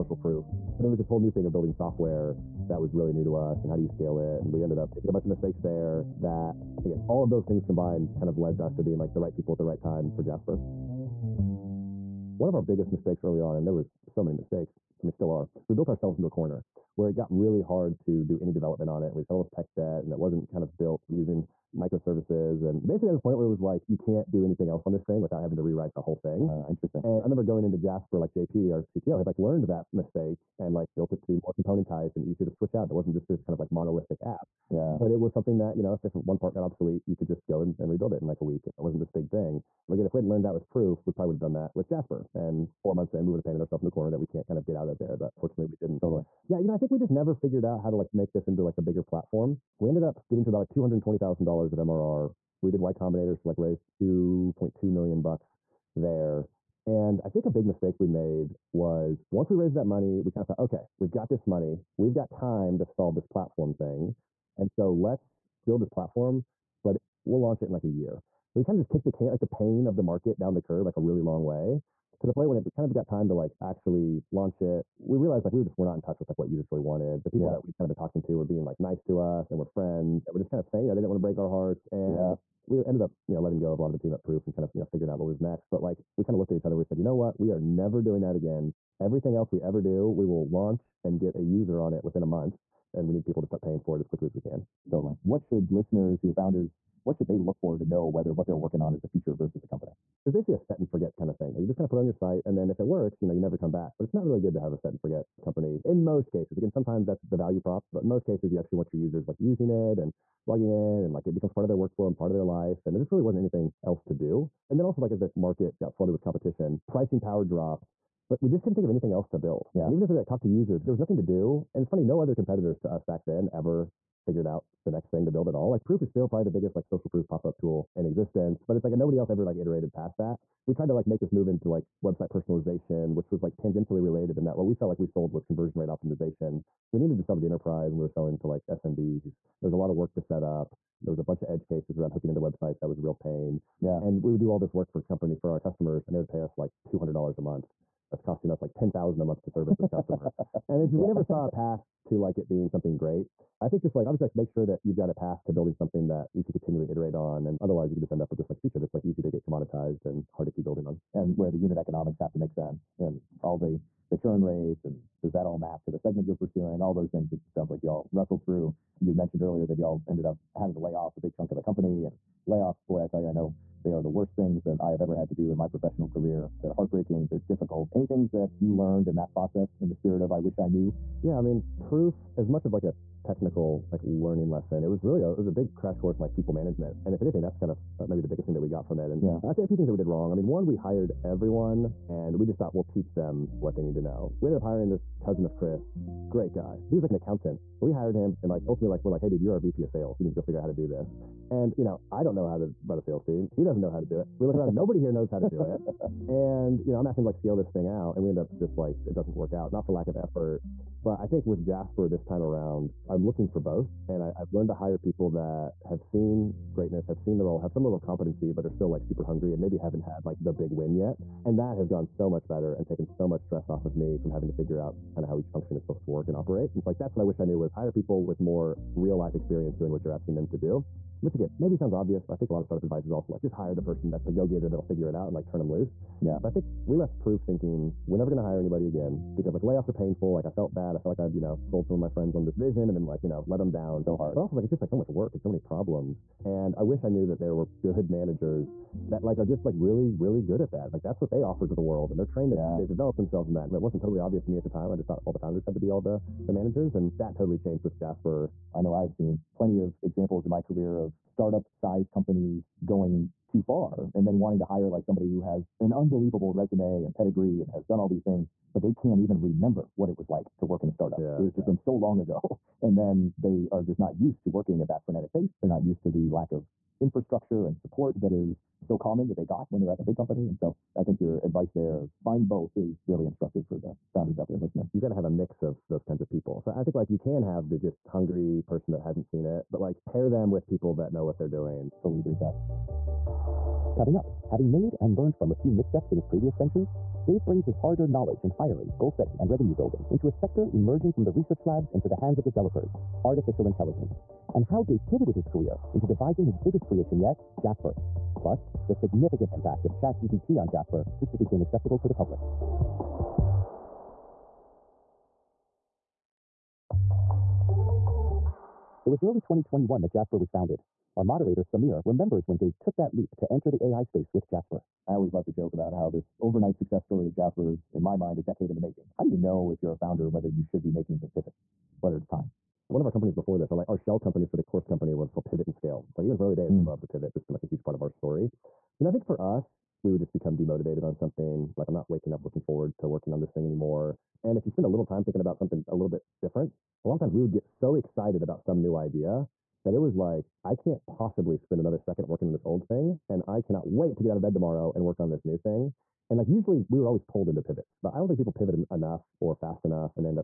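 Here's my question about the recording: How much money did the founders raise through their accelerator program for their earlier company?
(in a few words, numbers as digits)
$2.2 million.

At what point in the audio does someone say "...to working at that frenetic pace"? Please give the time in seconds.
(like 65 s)
274 s.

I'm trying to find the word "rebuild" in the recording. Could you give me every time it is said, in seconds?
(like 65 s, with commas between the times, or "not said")
37 s.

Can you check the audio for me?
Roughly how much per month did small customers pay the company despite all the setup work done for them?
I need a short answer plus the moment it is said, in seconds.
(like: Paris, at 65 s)
$200, at 146 s.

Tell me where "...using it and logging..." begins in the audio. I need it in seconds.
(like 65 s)
109 s.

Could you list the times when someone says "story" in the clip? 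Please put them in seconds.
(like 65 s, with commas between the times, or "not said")
327 s, 338 s.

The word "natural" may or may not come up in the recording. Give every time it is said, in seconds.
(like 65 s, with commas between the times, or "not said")
not said.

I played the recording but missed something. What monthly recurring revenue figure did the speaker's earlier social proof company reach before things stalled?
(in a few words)
$220,000.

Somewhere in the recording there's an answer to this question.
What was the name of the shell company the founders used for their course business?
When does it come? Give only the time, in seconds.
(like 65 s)
335 s.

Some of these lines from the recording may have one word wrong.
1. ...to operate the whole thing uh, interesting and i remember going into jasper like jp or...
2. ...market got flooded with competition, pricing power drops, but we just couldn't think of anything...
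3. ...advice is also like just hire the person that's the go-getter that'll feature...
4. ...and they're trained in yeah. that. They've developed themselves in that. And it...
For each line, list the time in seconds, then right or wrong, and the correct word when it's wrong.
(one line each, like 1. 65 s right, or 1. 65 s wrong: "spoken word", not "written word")
1. 25 s wrong: "rewrite", not "operate"
2. 115 s right
3. 232 s wrong: "figure", not "feature"
4. 252 s right.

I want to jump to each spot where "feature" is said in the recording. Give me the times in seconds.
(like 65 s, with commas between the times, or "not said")
99 s, 158 s.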